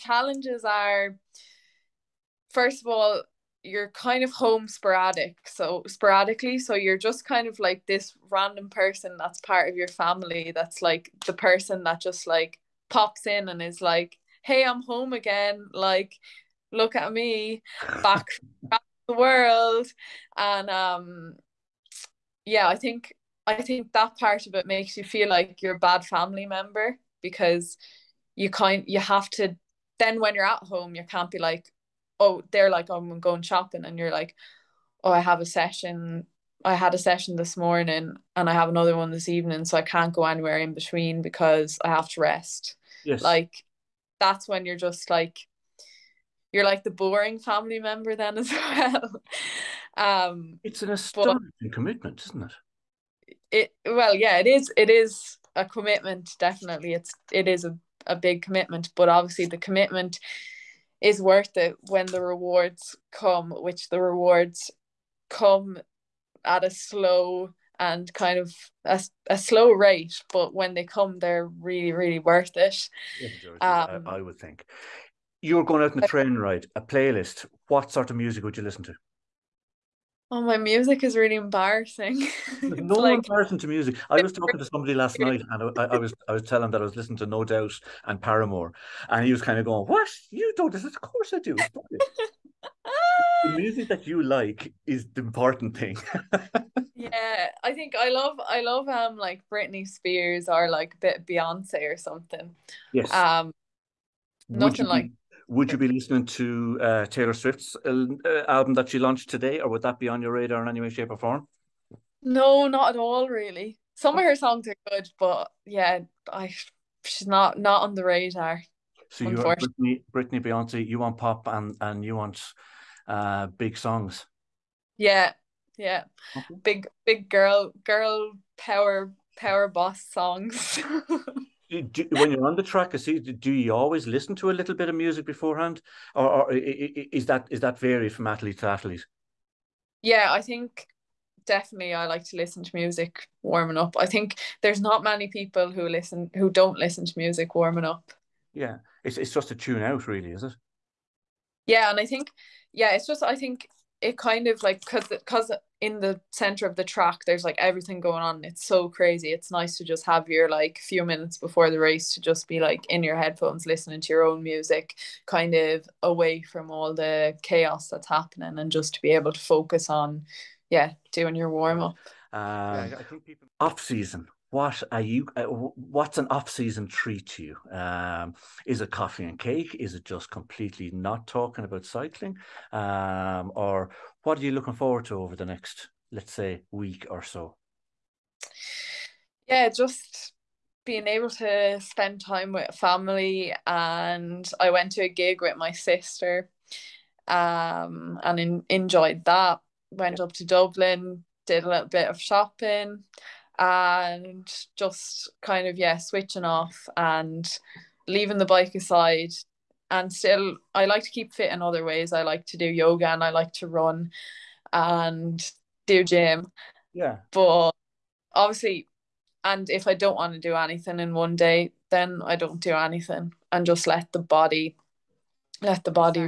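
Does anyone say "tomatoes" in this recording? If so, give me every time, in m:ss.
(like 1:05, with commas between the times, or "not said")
not said.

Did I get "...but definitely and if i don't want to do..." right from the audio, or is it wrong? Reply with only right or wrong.
wrong.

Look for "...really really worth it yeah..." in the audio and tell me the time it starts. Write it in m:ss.
1:11.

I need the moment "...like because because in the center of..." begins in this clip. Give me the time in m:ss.
2:34.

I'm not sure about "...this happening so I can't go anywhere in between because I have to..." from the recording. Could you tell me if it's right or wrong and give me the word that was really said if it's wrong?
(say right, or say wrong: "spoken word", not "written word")
wrong: "evening", not "happening".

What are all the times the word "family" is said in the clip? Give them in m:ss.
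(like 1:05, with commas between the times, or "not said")
0:09, 0:26, 0:47, 3:12.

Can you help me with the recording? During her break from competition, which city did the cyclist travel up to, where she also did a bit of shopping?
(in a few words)
Dublin.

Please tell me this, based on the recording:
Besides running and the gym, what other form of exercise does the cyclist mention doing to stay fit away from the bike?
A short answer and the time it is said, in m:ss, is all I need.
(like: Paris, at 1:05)
Yoga, at 3:32.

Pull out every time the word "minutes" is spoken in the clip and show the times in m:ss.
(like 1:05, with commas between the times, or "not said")
2:41.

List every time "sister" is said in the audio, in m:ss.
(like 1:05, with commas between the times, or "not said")
3:15.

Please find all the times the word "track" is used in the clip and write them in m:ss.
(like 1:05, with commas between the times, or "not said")
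2:12, 2:36.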